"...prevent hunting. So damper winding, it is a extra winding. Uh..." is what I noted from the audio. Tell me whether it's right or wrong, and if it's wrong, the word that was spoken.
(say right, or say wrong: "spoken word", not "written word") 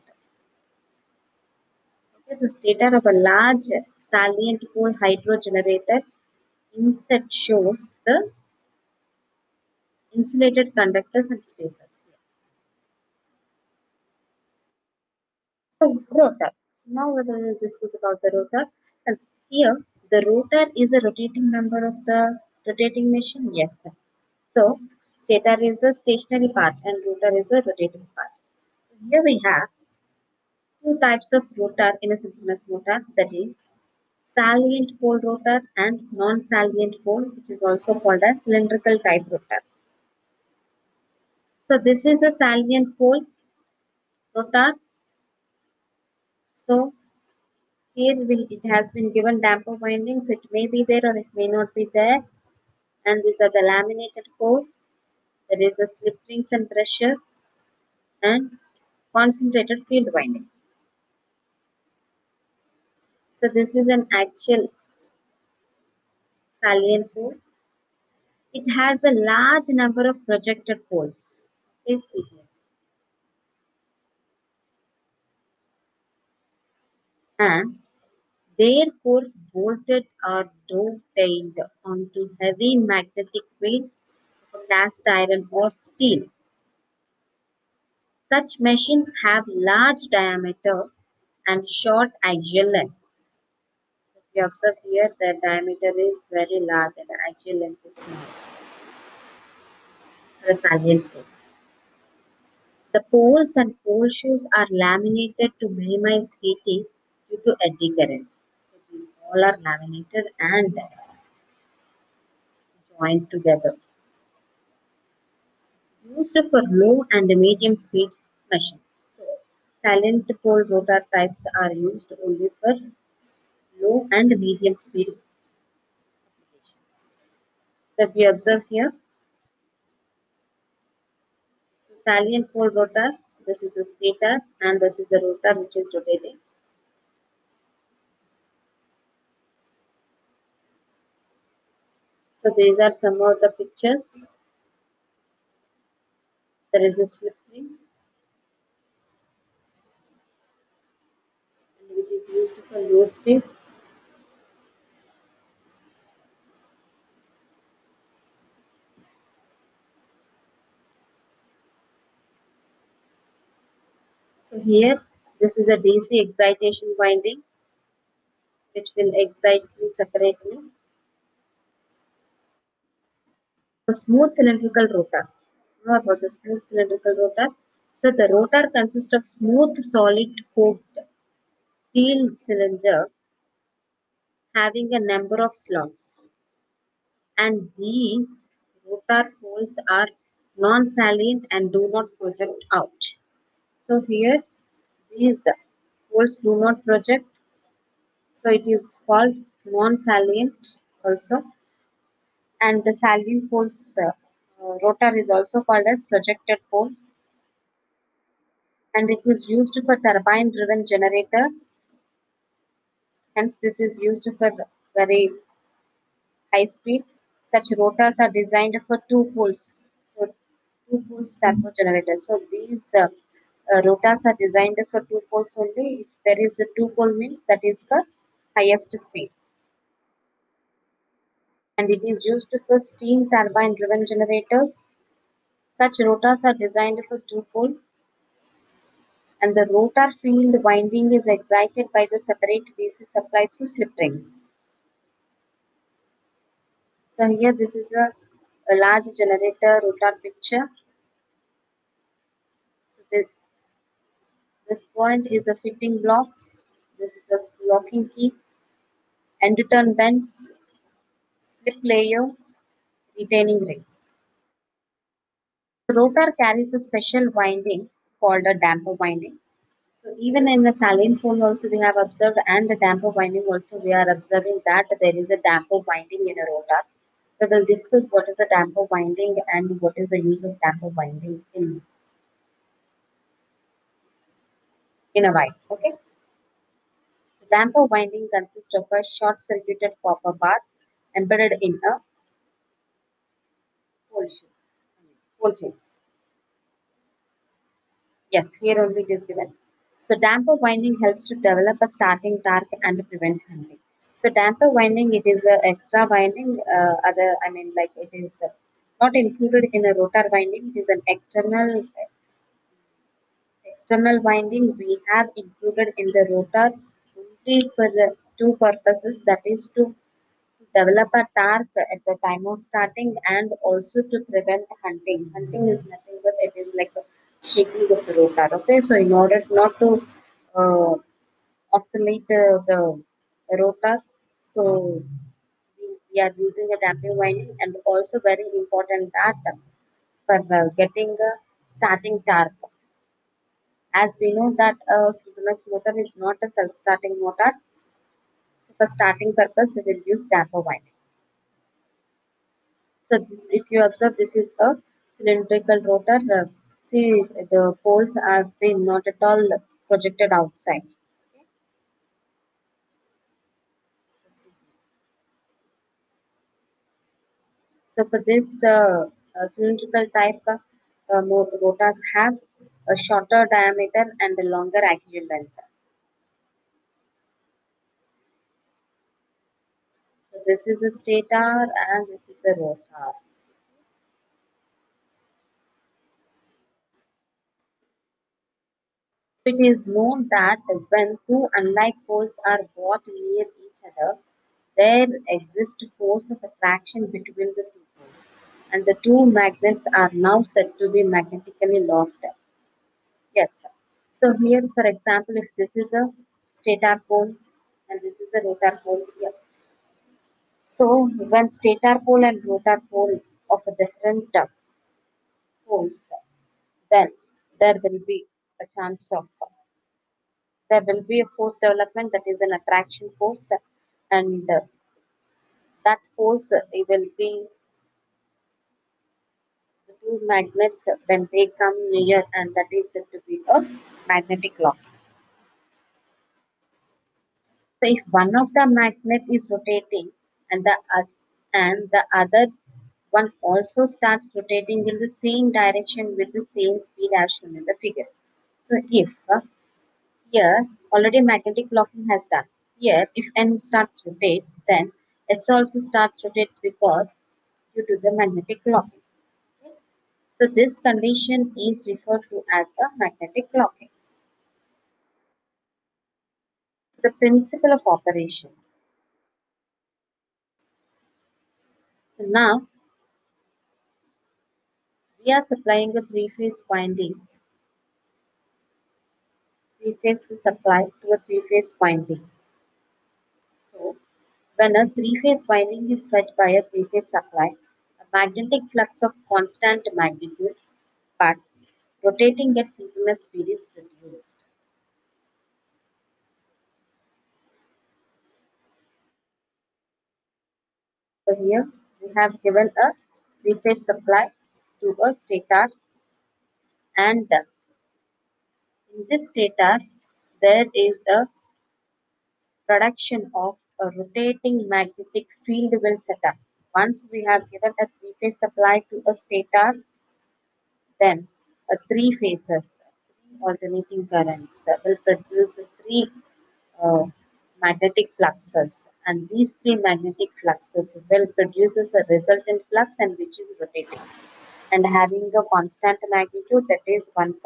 right.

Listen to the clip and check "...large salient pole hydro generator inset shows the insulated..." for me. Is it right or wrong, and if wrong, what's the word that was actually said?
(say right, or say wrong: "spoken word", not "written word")
right.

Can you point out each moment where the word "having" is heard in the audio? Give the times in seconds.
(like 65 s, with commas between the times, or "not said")
184 s, 534 s.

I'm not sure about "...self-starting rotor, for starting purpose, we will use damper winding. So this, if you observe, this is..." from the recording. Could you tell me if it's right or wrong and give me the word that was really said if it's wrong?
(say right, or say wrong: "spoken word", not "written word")
wrong: "motor", not "rotor".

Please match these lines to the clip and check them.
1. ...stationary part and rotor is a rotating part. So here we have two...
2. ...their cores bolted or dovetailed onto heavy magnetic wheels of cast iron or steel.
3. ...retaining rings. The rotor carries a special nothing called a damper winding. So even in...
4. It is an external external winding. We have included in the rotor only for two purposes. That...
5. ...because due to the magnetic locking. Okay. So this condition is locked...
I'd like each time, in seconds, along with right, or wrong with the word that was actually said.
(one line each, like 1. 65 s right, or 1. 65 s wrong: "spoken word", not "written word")
1. 25 s right
2. 78 s right
3. 263 s wrong: "winding", not "nothing"
4. 310 s right
5. 456 s wrong: "referred", not "locked".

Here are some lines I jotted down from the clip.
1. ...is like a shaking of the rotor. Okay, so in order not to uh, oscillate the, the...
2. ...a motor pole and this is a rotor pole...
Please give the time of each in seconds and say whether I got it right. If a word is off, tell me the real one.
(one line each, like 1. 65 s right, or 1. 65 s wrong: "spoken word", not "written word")
1. 326 s right
2. 405 s wrong: "stator", not "motor".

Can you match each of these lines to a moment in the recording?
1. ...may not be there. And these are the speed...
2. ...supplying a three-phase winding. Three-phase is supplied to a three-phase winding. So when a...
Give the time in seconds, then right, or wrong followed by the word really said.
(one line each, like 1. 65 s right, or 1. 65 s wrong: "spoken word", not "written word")
1. 51 s wrong: "laminated", not "speed"
2. 475 s right.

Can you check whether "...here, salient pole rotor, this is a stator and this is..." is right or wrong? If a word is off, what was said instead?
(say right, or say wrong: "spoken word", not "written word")
right.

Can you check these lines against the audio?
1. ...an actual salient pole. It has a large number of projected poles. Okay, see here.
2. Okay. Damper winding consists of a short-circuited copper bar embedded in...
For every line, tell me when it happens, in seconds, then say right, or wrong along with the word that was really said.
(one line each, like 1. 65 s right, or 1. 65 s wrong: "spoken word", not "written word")
1. 63 s right
2. 285 s right.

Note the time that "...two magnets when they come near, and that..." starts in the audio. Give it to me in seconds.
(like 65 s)
430 s.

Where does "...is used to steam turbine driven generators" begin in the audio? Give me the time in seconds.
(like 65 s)
232 s.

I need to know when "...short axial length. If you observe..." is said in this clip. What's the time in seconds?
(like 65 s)
91 s.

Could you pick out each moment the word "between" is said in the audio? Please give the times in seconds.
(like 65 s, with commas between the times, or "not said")
397 s.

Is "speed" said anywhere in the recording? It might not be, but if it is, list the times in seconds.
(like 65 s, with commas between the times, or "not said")
117 s, 124 s, 153 s, 216 s, 228 s, 446 s, 493 s.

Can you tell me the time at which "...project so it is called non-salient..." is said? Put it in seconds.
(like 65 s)
196 s.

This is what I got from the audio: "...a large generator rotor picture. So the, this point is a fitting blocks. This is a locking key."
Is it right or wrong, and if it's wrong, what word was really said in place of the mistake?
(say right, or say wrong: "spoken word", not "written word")
right.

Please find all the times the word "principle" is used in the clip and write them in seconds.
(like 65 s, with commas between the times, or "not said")
467 s.